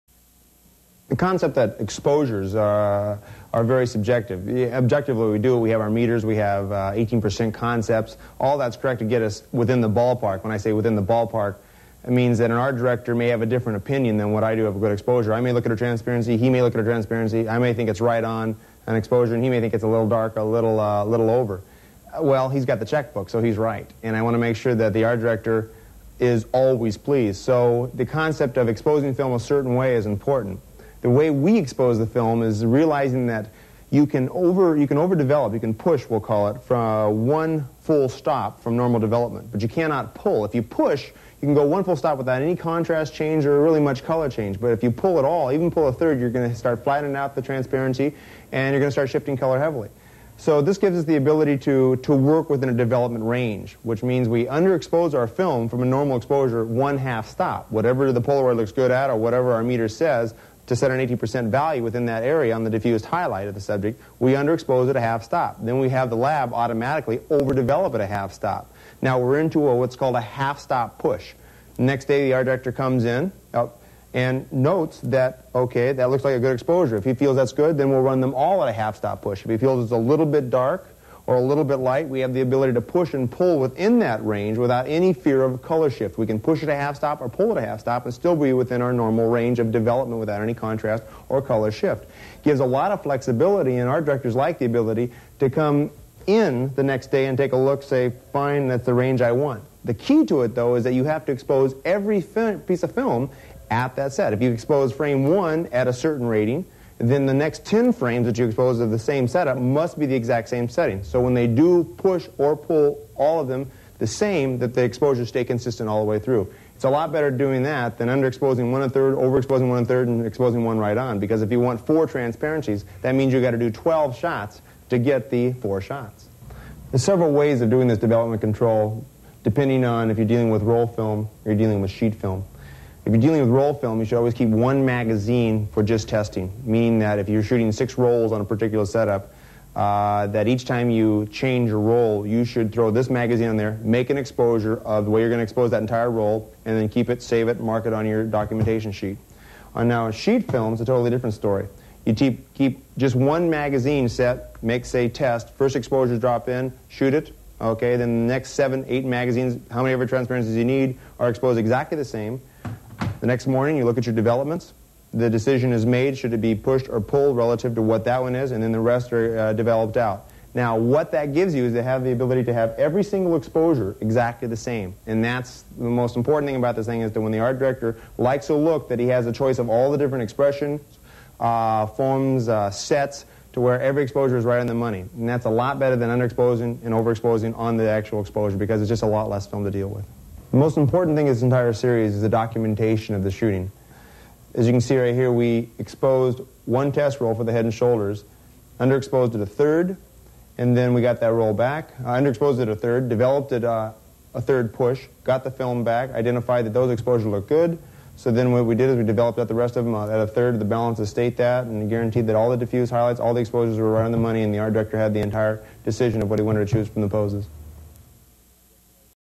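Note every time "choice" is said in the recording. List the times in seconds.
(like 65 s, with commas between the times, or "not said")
179 s.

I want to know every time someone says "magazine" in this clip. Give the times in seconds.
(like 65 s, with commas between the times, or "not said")
134 s, 143 s, 153 s, 159 s.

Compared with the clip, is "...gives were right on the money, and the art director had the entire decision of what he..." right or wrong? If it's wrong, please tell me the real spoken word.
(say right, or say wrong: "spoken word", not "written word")
wrong: "exposures", not "gives".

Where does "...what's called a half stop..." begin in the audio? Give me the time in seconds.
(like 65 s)
69 s.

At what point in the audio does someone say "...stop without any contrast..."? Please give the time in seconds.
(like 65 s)
41 s.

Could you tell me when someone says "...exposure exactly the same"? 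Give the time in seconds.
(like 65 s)
173 s.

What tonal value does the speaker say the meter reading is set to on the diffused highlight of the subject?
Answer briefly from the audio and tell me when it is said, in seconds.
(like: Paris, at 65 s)
80%, at 61 s.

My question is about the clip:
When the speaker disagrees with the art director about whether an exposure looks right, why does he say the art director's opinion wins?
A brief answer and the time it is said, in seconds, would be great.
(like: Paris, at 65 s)
He's got the checkbook, at 22 s.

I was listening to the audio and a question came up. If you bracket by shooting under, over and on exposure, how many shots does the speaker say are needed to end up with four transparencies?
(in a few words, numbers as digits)
12.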